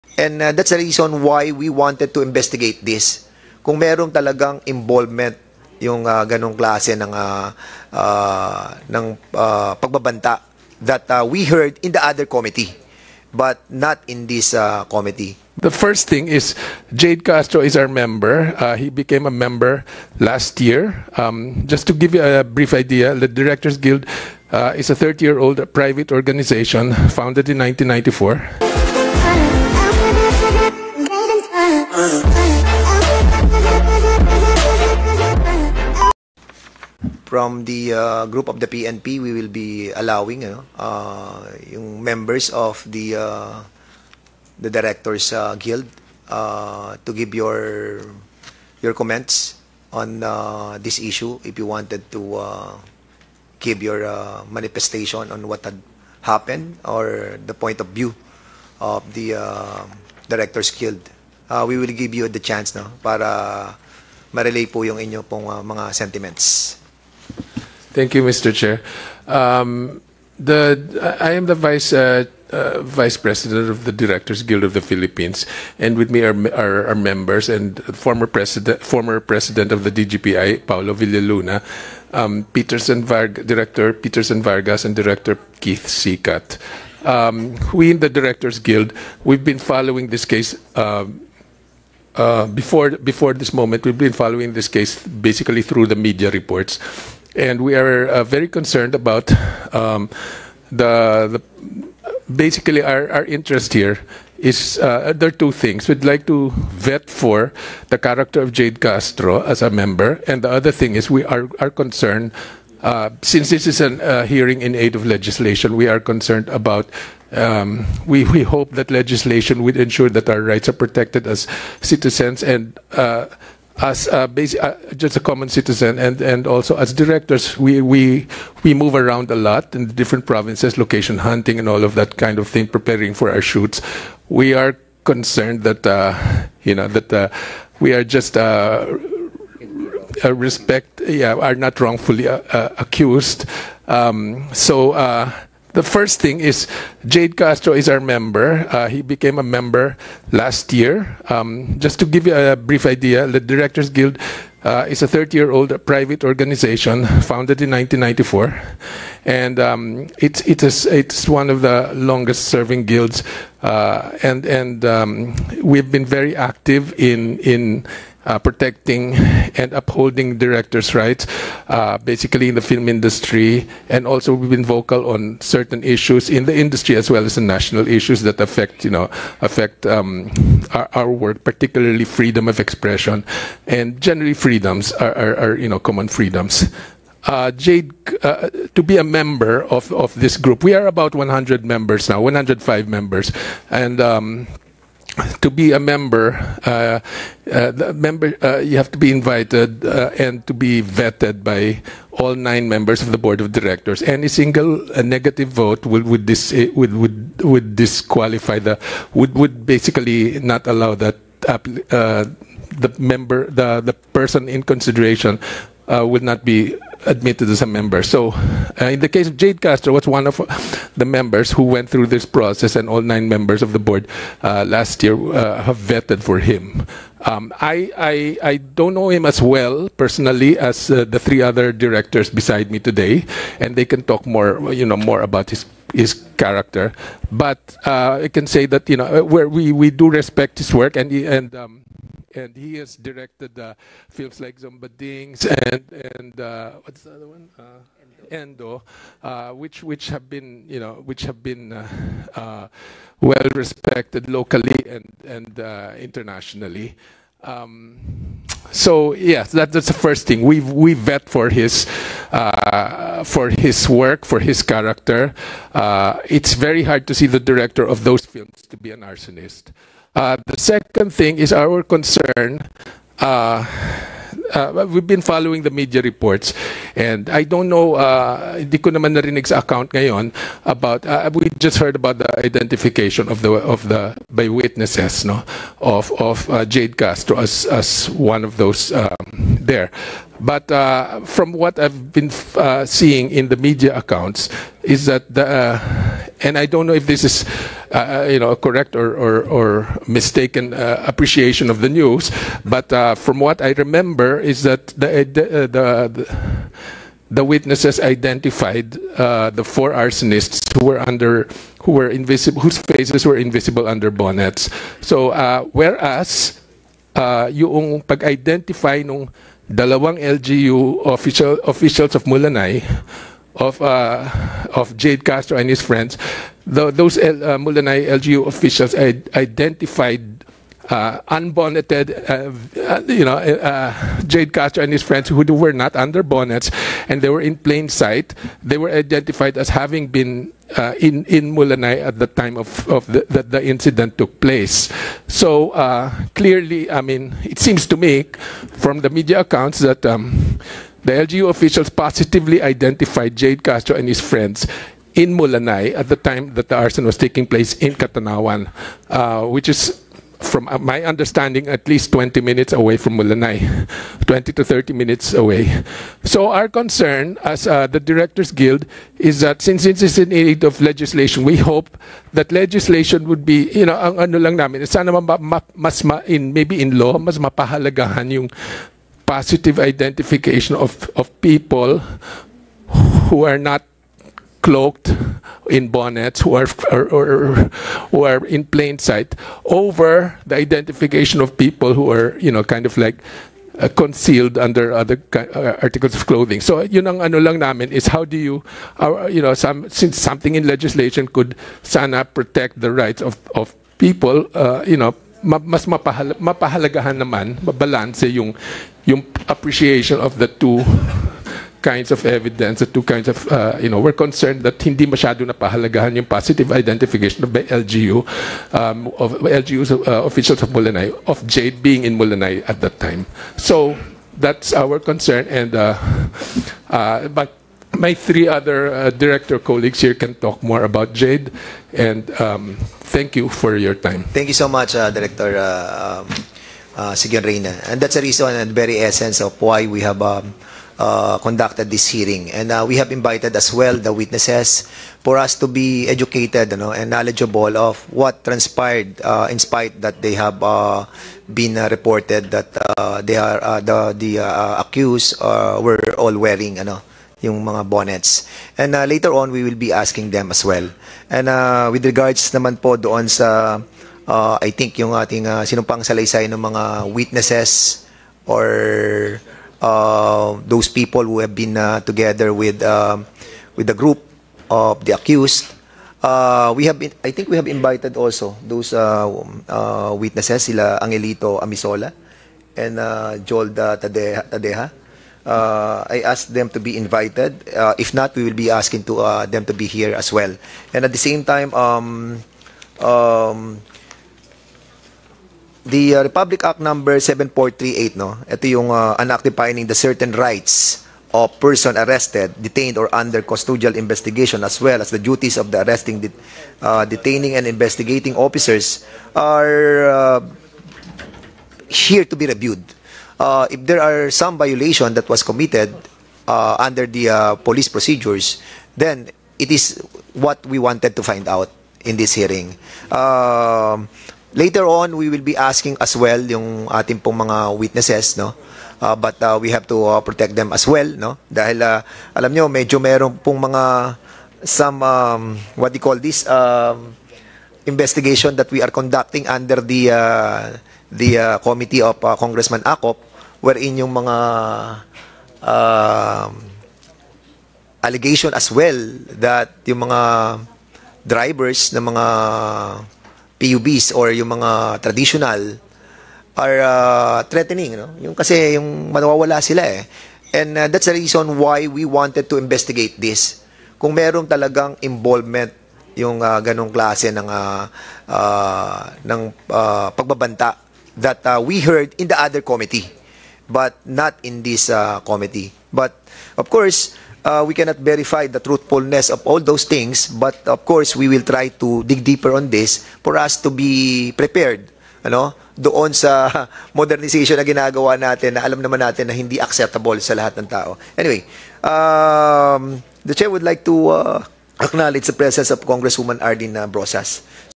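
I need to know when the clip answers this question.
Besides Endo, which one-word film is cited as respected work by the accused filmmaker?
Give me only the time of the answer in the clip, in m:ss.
4:04.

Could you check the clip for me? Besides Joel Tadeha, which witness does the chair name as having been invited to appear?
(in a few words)
Angelito Amisola.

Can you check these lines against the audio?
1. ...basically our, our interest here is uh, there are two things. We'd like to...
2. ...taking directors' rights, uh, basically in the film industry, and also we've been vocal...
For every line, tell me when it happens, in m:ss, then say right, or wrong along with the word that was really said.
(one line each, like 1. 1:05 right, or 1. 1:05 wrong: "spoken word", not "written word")
1. 1:42 right
2. 2:49 wrong: "upholding", not "taking".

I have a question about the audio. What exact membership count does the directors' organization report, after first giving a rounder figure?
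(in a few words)
105.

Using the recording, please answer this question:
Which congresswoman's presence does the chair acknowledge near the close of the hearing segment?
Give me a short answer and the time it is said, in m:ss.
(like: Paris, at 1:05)
Ardina Brosas, at 9:56.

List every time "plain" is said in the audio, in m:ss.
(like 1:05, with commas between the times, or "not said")
5:37, 6:28.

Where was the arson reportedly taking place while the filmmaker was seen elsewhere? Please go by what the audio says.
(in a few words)
Catanauan.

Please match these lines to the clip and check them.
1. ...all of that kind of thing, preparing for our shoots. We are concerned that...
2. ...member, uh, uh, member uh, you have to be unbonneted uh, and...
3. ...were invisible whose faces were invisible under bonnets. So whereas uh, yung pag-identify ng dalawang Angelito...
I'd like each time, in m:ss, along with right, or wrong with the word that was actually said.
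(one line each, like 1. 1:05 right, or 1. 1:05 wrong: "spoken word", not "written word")
1. 2:11 right
2. 3:15 wrong: "invited", not "unbonneted"
3. 5:11 wrong: "LGU", not "Angelito".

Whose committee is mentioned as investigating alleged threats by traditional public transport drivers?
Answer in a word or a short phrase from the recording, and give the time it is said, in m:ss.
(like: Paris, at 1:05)
Congressman Acop, at 9:02.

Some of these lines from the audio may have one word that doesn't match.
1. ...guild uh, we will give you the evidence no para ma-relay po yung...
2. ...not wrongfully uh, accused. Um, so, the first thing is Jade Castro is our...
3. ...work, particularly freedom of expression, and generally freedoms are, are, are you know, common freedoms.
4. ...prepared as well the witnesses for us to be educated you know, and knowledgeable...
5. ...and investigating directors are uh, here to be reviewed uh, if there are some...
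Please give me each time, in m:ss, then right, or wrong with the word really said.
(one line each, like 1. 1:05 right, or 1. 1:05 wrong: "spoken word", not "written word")
1. 1:00 wrong: "chance", not "evidence"
2. 2:21 right
3. 3:01 right
4. 7:23 wrong: "invited", not "prepared"
5. 8:27 wrong: "officers", not "directors".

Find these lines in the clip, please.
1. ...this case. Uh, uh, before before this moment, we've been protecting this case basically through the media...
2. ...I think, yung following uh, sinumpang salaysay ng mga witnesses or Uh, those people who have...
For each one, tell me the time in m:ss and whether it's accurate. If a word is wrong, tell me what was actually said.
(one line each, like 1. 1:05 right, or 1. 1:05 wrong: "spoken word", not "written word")
1. 1:30 wrong: "following", not "protecting"
2. 7:44 wrong: "ating", not "following".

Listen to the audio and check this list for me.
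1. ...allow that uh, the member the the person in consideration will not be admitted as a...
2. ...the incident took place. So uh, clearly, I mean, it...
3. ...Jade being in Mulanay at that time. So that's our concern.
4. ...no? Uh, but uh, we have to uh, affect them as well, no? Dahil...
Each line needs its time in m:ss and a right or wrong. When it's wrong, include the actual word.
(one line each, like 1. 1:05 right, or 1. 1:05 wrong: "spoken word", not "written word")
1. 3:30 right
2. 5:43 right
3. 7:01 right
4. 8:48 wrong: "protect", not "affect".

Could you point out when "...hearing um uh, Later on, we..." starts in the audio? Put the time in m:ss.
8:42.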